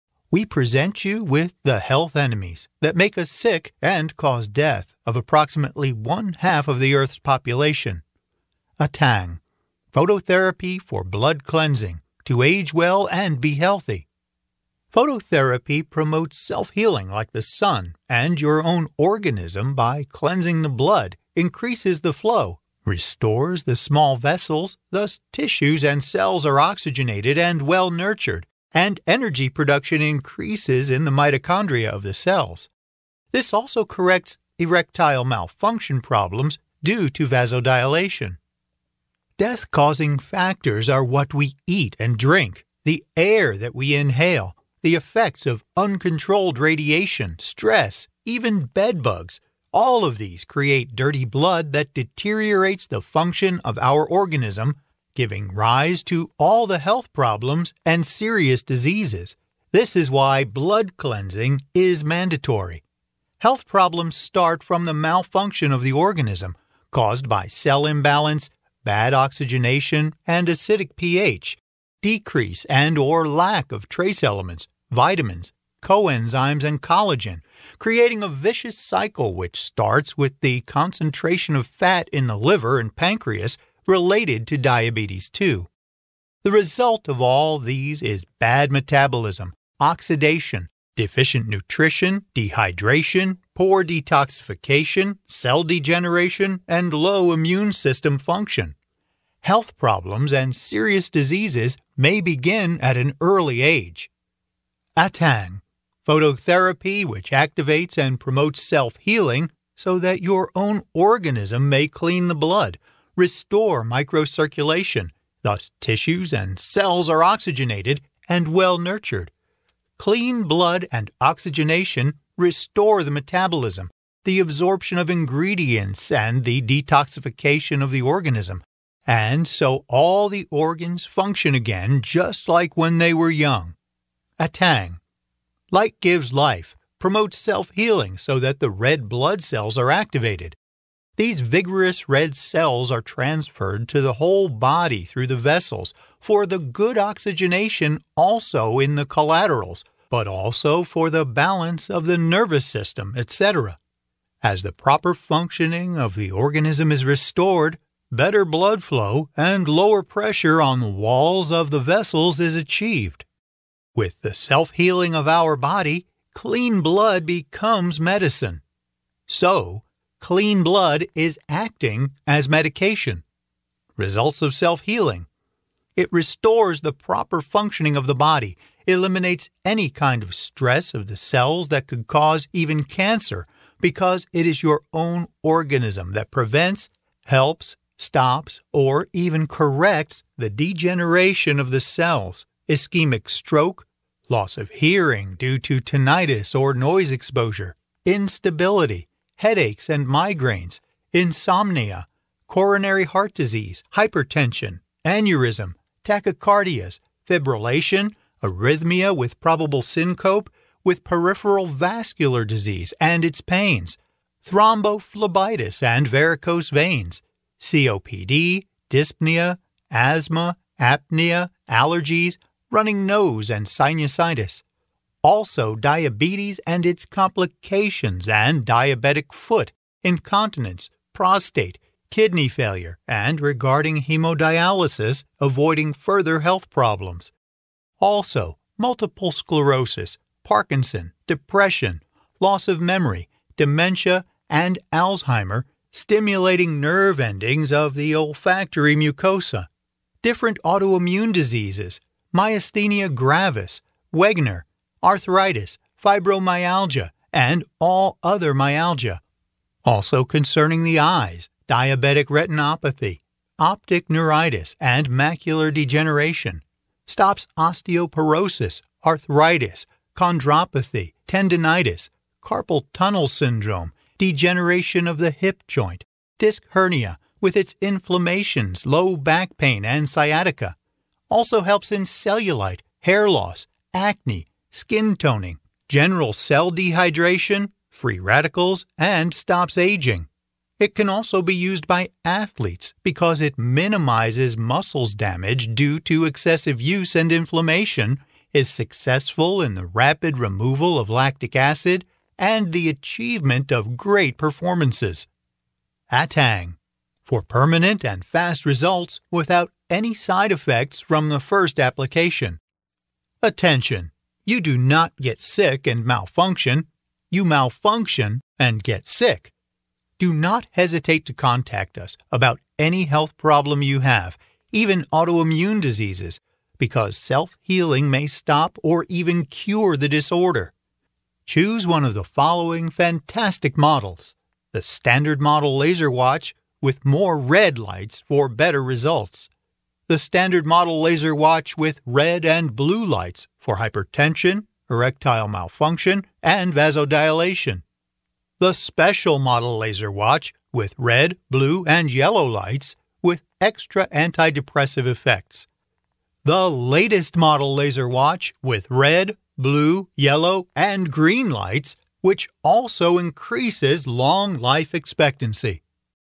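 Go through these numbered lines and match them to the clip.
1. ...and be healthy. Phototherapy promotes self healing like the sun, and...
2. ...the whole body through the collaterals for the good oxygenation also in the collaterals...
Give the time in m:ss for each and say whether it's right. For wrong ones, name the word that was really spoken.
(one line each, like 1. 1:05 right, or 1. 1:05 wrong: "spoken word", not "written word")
1. 0:13 right
2. 2:24 wrong: "vessels", not "collaterals".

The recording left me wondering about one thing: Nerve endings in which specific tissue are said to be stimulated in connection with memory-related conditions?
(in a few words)
olfactory mucosa.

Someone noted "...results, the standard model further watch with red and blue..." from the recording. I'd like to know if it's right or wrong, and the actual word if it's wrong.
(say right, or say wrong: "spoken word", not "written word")
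wrong: "laser", not "further".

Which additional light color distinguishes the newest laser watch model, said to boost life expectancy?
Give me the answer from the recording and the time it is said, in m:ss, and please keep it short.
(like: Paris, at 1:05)
green, at 6:01.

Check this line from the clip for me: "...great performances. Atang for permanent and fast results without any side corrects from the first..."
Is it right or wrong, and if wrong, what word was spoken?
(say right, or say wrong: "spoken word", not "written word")
wrong: "effects", not "corrects".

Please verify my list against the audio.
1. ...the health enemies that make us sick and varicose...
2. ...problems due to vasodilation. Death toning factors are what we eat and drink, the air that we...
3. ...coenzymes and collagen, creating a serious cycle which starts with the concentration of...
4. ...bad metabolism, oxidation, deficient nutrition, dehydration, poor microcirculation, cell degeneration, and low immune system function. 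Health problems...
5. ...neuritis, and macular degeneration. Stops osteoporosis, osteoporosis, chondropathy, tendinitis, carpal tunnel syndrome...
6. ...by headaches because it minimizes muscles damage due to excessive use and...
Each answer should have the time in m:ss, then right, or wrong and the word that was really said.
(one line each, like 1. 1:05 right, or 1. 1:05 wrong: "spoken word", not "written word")
1. 0:01 wrong: "cause", not "varicose"
2. 0:36 wrong: "causing", not "toning"
3. 1:15 wrong: "vicious", not "serious"
4. 1:28 wrong: "detoxification", not "microcirculation"
5. 4:24 wrong: "arthritis", not "osteoporosis"
6. 4:51 wrong: "athletes", not "headaches".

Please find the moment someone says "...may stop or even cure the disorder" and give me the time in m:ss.
5:28.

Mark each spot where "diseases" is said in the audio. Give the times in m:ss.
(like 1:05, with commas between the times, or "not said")
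0:58, 1:41, 3:23, 3:32, 4:11, 5:25.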